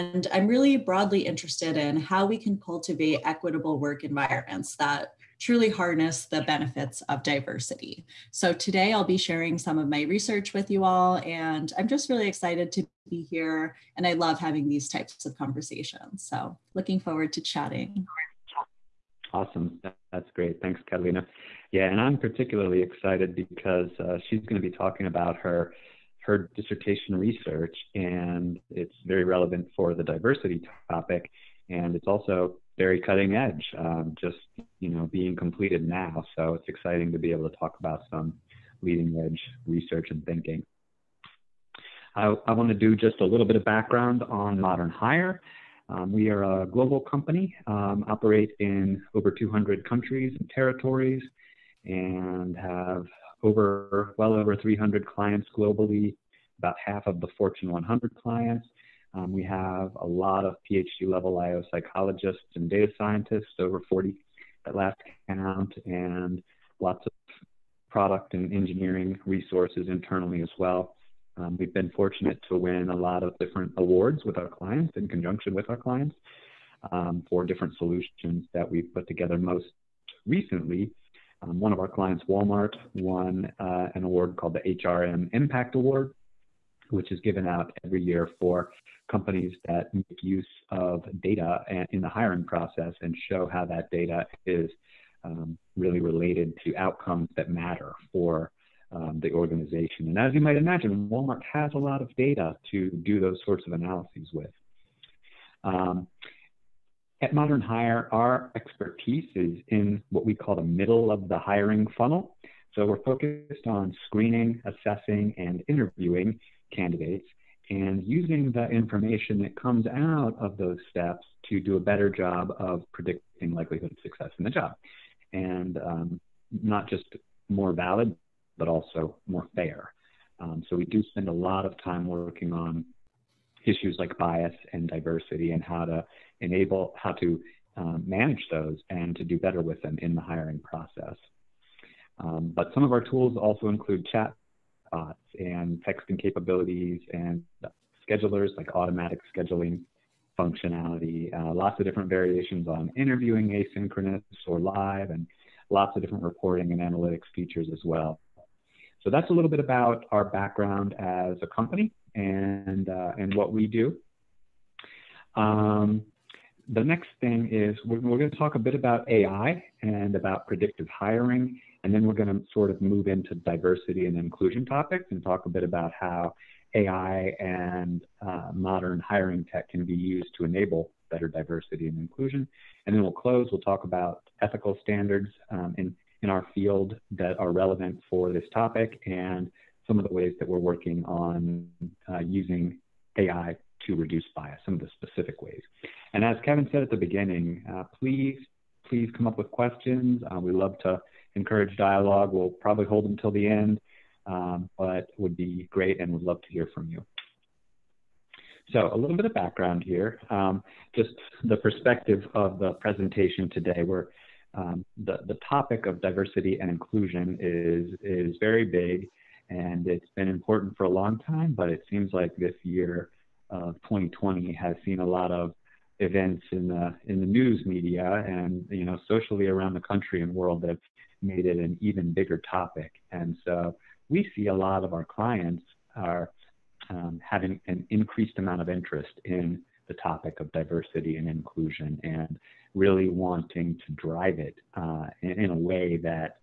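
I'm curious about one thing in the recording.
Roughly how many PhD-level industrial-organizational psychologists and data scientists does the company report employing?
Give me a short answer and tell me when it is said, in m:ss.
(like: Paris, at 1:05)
over 40, at 1:03.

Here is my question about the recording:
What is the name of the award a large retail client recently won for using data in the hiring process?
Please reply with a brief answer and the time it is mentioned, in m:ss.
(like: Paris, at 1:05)
HRM Impact Award, at 1:24.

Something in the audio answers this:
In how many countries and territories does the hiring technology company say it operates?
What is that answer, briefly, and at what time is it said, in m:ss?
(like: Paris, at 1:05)
over 200, at 0:49.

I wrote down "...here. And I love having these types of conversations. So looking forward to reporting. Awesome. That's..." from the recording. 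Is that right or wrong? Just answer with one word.
wrong.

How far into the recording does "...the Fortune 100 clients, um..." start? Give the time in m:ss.
0:57.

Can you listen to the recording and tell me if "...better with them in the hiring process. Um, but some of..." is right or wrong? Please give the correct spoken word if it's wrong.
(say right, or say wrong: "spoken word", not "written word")
right.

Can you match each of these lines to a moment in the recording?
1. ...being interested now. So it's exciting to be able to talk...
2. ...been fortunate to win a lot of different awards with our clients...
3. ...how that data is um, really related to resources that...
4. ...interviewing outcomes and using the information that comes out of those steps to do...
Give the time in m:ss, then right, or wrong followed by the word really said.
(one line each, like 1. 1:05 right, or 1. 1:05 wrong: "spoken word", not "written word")
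1. 0:35 wrong: "completed", not "interested"
2. 1:11 right
3. 1:33 wrong: "outcomes", not "resources"
4. 1:55 wrong: "candidates", not "outcomes".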